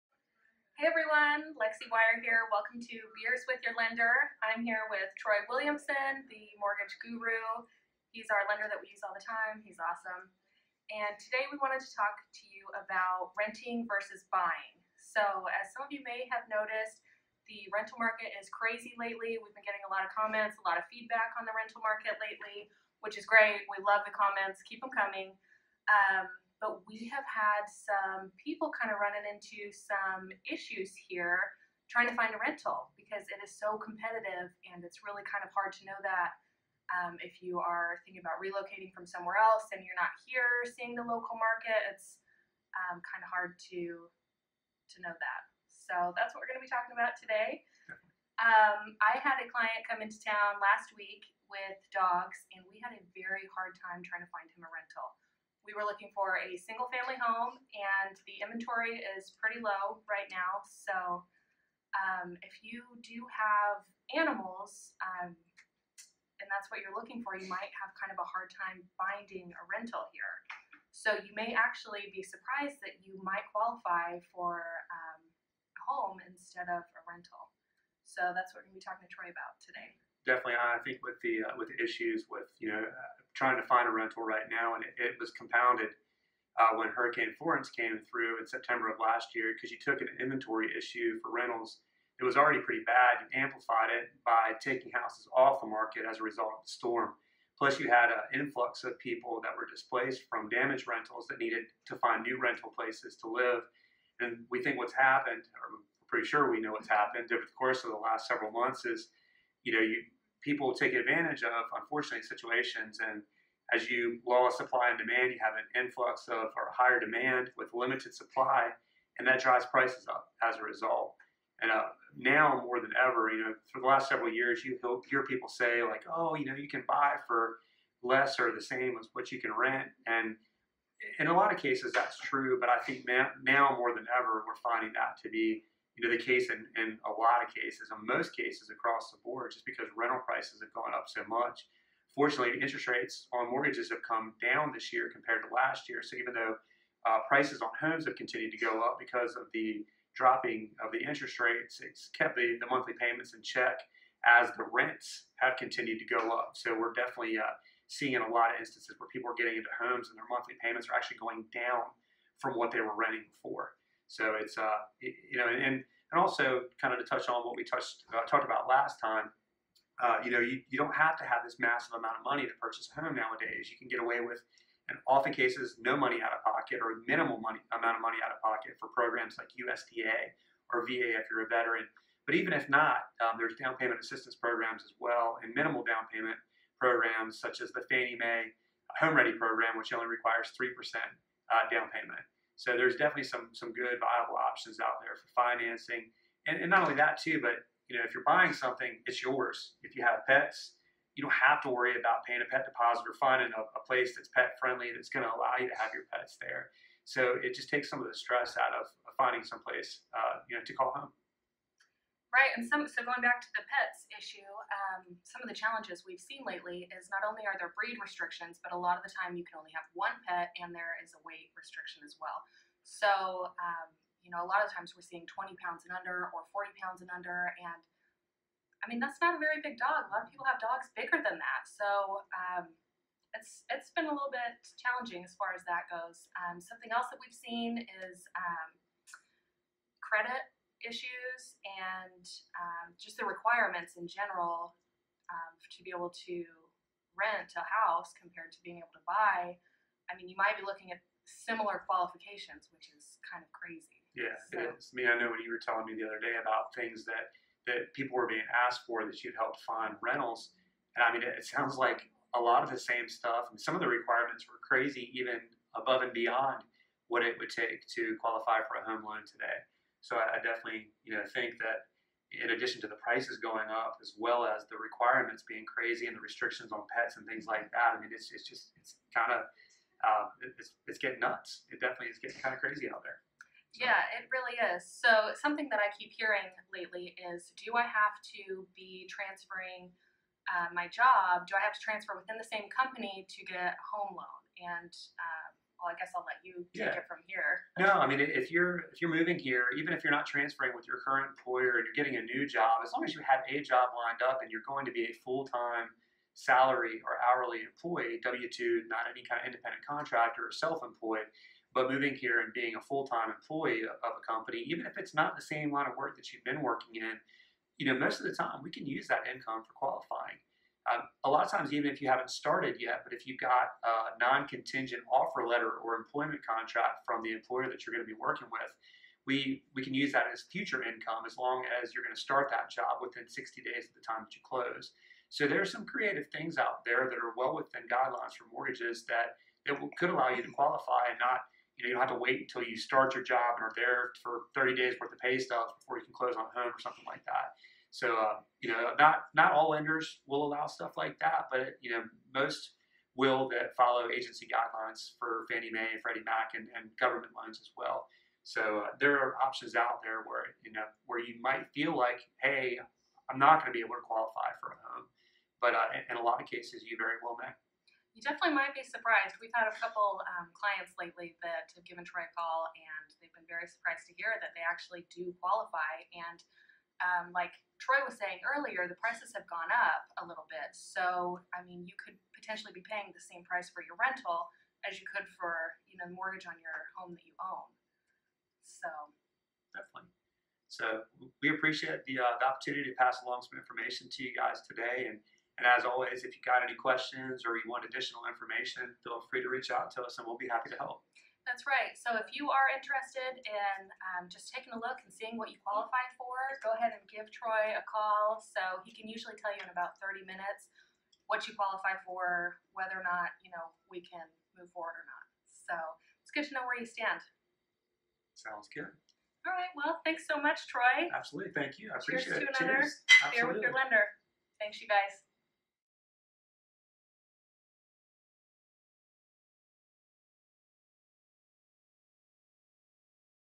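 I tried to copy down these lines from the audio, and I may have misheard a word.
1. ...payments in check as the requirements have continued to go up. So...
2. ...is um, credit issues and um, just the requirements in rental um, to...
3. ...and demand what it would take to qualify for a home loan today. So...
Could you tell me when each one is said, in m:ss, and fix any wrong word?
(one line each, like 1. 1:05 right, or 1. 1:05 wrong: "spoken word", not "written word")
1. 2:32 wrong: "rents", not "requirements"
2. 3:58 wrong: "general", not "rental"
3. 4:26 wrong: "beyond", not "demand".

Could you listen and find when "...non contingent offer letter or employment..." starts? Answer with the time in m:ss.
5:24.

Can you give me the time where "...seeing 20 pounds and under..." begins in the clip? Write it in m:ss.
3:45.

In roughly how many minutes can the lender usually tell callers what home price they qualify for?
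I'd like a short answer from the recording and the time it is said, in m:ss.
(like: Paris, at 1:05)
30 minutes, at 6:49.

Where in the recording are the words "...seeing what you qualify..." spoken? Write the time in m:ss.
6:45.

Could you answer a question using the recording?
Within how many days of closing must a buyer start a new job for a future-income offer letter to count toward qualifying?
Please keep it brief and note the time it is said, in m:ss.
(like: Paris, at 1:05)
60 days, at 5:33.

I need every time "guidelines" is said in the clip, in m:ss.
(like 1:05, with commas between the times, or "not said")
5:37, 5:54.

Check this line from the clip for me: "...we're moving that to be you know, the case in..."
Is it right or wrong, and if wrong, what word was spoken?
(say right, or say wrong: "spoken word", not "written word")
wrong: "finding", not "moving".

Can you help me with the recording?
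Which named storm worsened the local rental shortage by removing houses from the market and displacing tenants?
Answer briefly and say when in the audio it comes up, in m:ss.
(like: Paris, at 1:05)
Hurricane Florence, at 1:26.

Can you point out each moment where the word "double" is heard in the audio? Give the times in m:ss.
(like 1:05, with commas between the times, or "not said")
not said.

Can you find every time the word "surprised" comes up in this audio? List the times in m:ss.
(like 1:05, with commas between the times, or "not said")
1:12, 6:08, 6:13.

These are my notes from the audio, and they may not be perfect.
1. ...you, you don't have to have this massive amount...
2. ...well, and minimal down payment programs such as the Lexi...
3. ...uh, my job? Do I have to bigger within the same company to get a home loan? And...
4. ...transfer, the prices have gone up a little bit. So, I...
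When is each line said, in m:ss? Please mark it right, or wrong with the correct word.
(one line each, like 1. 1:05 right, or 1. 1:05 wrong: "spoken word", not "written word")
1. 2:50 right
2. 3:04 wrong: "Fannie", not "Lexi"
3. 4:50 wrong: "transfer", not "bigger"
4. 6:18 wrong: "earlier", not "transfer".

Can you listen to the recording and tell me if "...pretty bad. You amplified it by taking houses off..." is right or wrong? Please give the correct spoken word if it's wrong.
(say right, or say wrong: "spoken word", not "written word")
right.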